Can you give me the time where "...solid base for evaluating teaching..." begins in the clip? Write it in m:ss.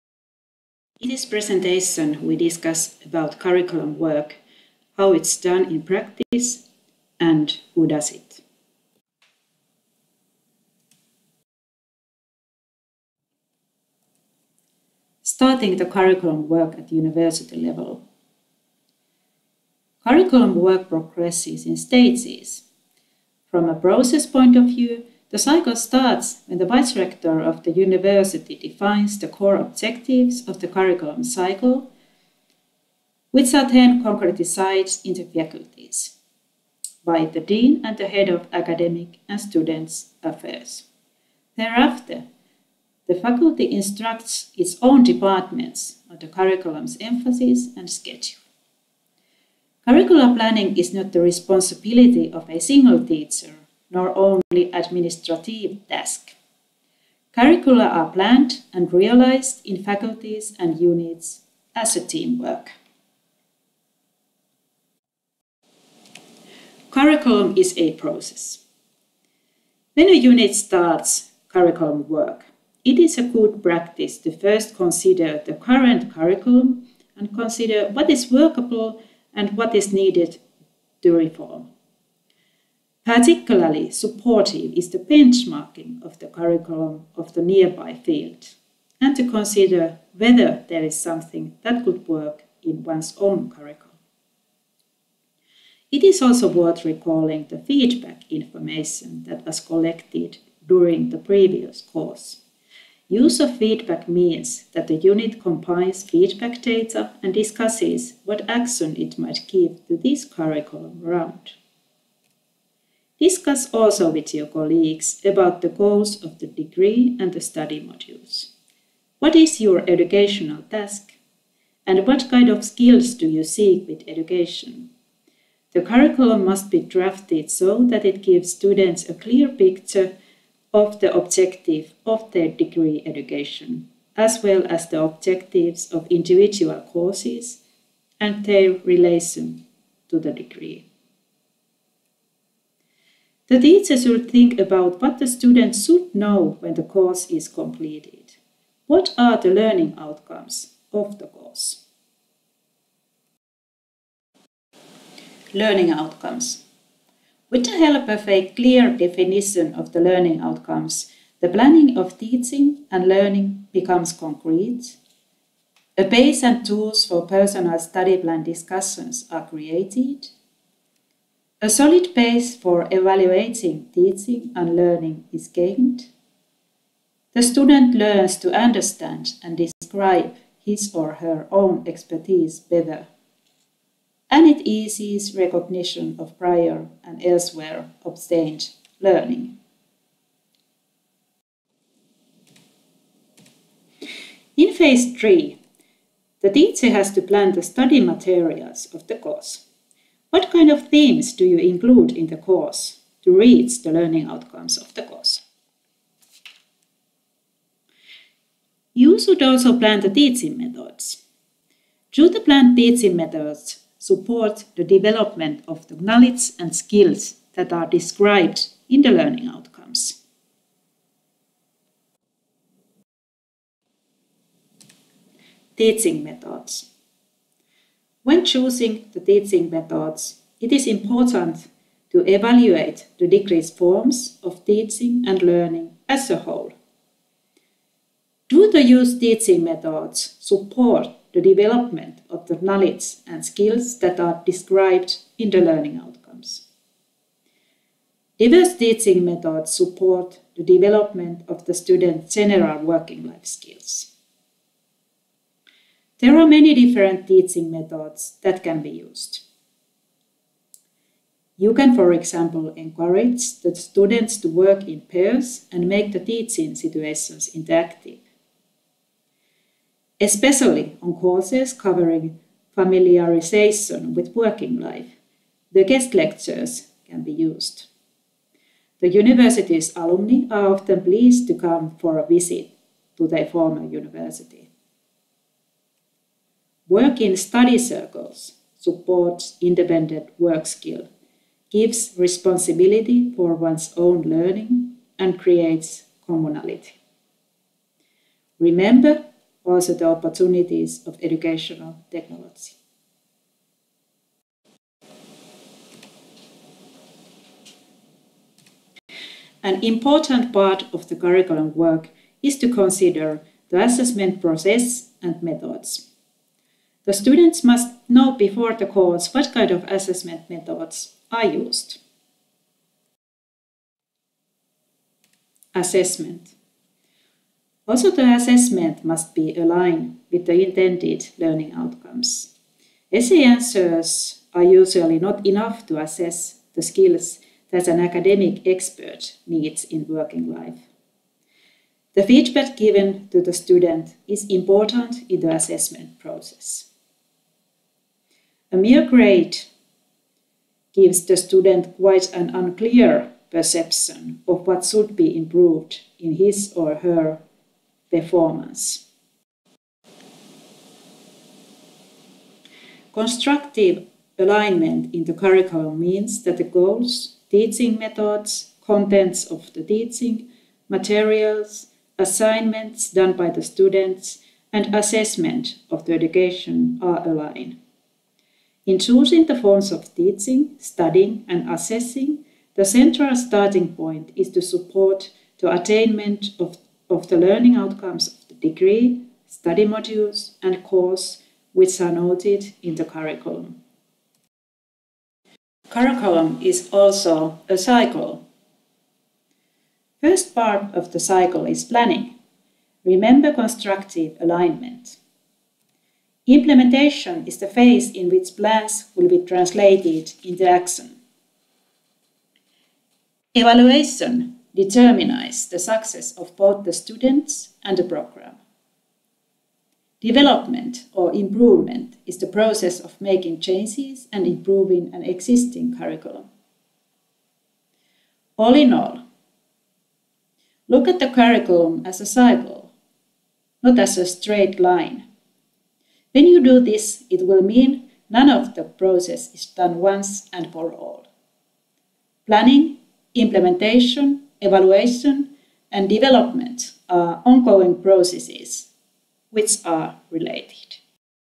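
2:51.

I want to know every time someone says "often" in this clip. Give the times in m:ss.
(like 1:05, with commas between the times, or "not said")
4:40.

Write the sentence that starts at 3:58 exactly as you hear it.
Do the used teaching methods support the development of the knowledge and skills that are described in the learning outcomes?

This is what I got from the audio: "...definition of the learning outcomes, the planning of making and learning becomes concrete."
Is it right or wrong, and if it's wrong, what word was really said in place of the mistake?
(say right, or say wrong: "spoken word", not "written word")
wrong: "teaching", not "making".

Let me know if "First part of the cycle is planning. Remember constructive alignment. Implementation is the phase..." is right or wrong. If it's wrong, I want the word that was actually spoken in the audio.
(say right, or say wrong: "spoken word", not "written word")
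right.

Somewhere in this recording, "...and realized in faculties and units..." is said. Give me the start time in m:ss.
0:58.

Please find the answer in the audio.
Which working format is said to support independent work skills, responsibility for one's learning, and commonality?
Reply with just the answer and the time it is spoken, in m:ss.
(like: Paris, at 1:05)
Study circles, at 4:47.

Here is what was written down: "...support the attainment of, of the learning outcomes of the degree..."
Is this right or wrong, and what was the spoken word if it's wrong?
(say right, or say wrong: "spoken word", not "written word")
right.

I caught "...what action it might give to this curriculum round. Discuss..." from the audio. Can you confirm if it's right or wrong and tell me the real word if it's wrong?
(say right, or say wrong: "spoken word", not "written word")
right.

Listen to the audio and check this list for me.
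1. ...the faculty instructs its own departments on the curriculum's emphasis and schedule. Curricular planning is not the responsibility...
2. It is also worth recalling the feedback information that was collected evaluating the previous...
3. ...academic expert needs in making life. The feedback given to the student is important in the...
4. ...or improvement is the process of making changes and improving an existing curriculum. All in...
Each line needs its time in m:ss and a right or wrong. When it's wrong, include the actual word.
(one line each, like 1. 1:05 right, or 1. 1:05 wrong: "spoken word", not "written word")
1. 0:43 right
2. 1:35 wrong: "during", not "evaluating"
3. 5:37 wrong: "working", not "making"
4. 7:01 right.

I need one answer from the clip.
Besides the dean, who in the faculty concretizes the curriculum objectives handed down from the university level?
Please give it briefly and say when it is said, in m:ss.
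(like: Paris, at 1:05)
Head of academic and students affairs, at 0:38.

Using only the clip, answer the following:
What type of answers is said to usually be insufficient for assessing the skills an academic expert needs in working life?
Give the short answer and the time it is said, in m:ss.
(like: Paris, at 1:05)
Essay answers, at 5:33.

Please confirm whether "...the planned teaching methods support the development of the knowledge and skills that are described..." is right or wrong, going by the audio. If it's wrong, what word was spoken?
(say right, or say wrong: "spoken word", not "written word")
right.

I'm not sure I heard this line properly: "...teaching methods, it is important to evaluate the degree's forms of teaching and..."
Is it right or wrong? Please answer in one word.
right.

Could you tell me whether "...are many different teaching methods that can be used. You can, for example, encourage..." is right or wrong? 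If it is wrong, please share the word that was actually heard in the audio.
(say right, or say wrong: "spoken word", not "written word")
right.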